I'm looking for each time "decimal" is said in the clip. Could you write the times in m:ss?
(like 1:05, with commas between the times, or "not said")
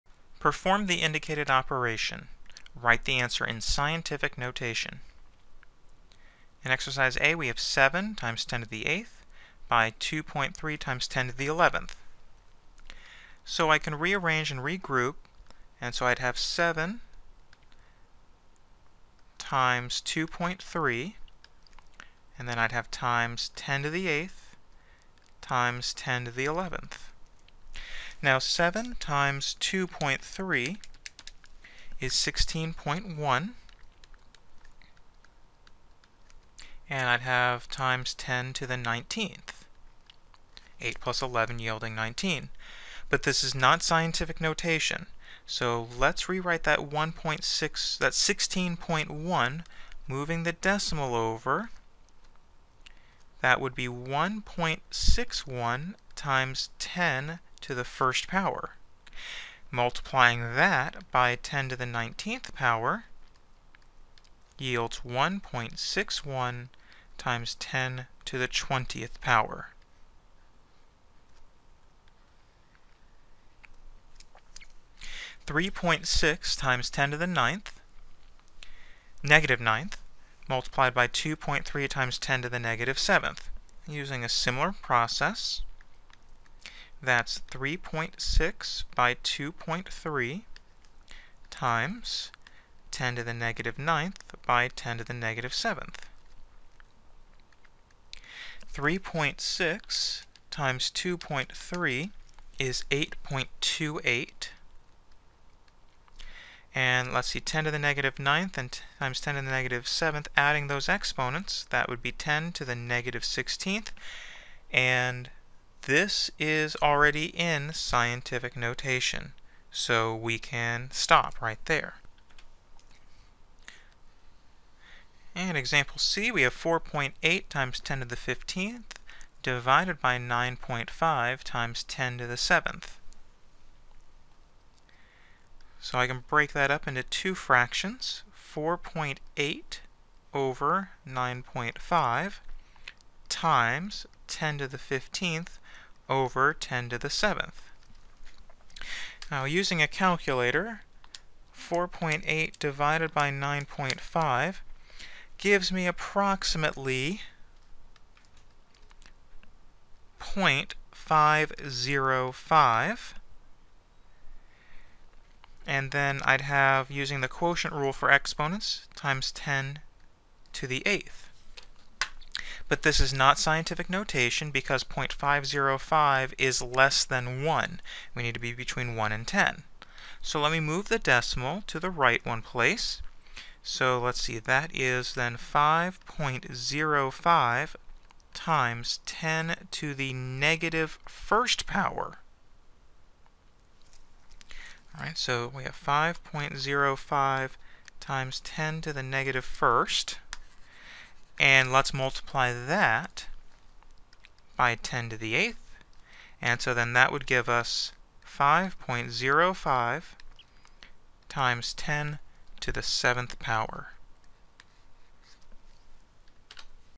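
0:50, 3:00.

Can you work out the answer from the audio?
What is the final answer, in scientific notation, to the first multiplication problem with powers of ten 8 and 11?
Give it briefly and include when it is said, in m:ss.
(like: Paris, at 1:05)
1.61 times 10^20, at 1:05.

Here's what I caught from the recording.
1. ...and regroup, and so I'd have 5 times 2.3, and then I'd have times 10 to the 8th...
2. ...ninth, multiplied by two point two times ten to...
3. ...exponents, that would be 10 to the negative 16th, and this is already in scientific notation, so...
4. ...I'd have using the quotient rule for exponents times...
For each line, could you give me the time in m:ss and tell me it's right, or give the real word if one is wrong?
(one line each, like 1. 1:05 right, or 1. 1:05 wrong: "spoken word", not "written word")
1. 0:14 wrong: "7", not "5"
2. 1:19 wrong: "three", not "two"
3. 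1:50 right
4. 2:46 right.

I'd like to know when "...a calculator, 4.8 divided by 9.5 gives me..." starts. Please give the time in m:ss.
2:29.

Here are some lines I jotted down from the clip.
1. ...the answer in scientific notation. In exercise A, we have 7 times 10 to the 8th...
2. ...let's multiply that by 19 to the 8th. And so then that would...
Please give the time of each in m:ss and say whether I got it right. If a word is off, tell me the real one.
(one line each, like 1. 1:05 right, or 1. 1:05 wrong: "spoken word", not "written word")
1. 0:03 right
2. 3:21 wrong: "10", not "19".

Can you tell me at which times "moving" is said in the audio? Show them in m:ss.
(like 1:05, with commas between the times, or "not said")
0:50.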